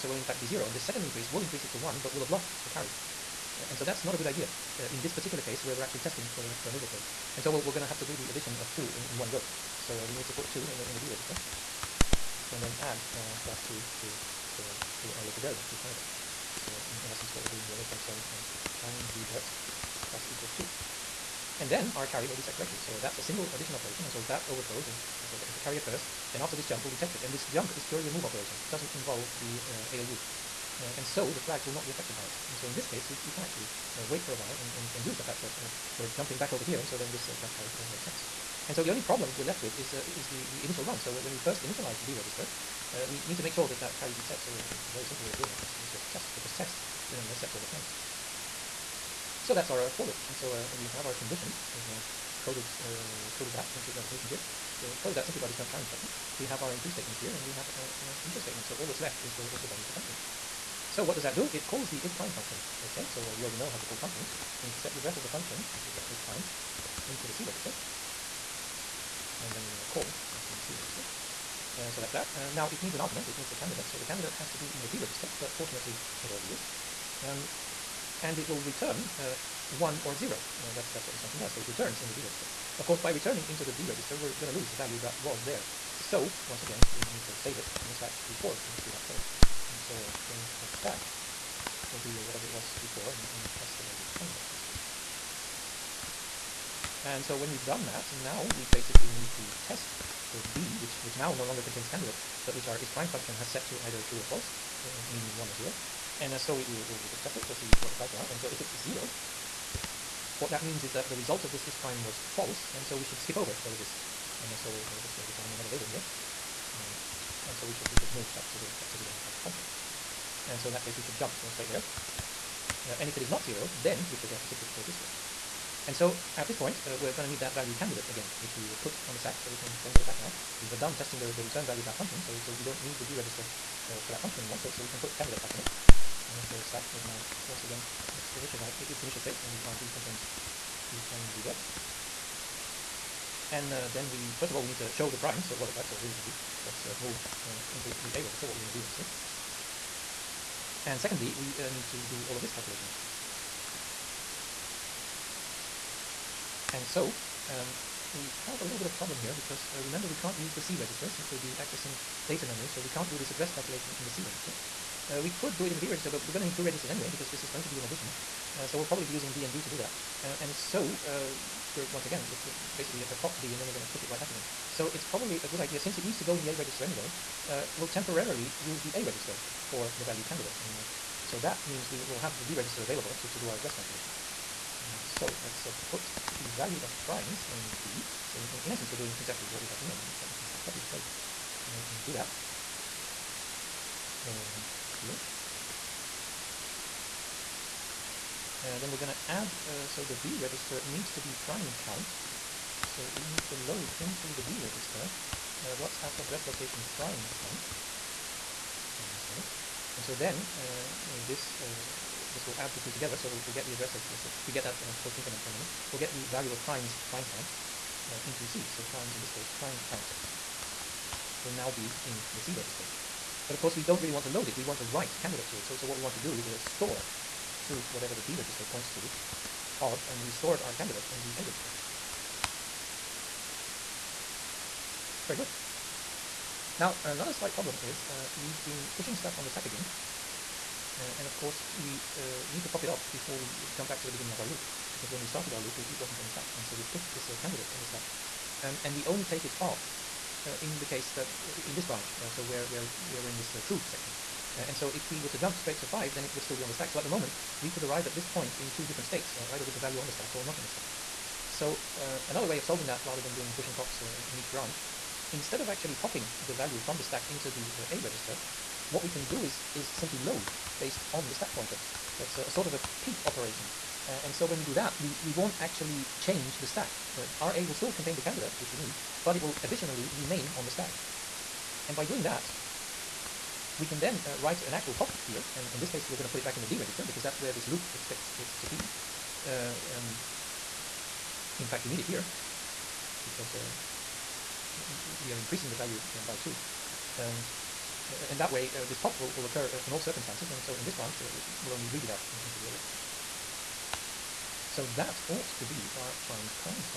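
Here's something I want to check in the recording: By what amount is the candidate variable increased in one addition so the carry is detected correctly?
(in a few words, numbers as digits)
2.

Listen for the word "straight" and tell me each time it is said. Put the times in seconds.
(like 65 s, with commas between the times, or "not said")
121 s, 255 s.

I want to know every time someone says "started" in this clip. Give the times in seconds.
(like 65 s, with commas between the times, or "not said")
245 s.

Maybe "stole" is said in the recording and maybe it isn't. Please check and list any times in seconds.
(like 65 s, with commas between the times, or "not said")
not said.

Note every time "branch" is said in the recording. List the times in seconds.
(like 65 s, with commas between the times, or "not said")
251 s, 264 s, 300 s.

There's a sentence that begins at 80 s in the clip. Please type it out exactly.
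Uh, that's, that's what this function does.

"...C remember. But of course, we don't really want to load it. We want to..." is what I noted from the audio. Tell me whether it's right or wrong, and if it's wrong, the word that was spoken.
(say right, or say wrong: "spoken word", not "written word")
wrong: "register", not "remember".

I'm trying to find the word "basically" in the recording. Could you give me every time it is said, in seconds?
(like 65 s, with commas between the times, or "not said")
98 s, 172 s.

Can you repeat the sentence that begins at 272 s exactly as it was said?
That's a, a sort of a peek operation.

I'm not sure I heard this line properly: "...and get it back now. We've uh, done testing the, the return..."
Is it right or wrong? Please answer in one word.
right.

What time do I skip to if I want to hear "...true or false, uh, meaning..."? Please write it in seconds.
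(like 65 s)
104 s.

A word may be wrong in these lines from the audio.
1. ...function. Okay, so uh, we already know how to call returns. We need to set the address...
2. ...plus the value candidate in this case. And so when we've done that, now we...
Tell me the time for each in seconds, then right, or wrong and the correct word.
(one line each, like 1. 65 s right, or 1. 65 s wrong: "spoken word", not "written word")
1. 62 s wrong: "functions", not "returns"
2. 93 s right.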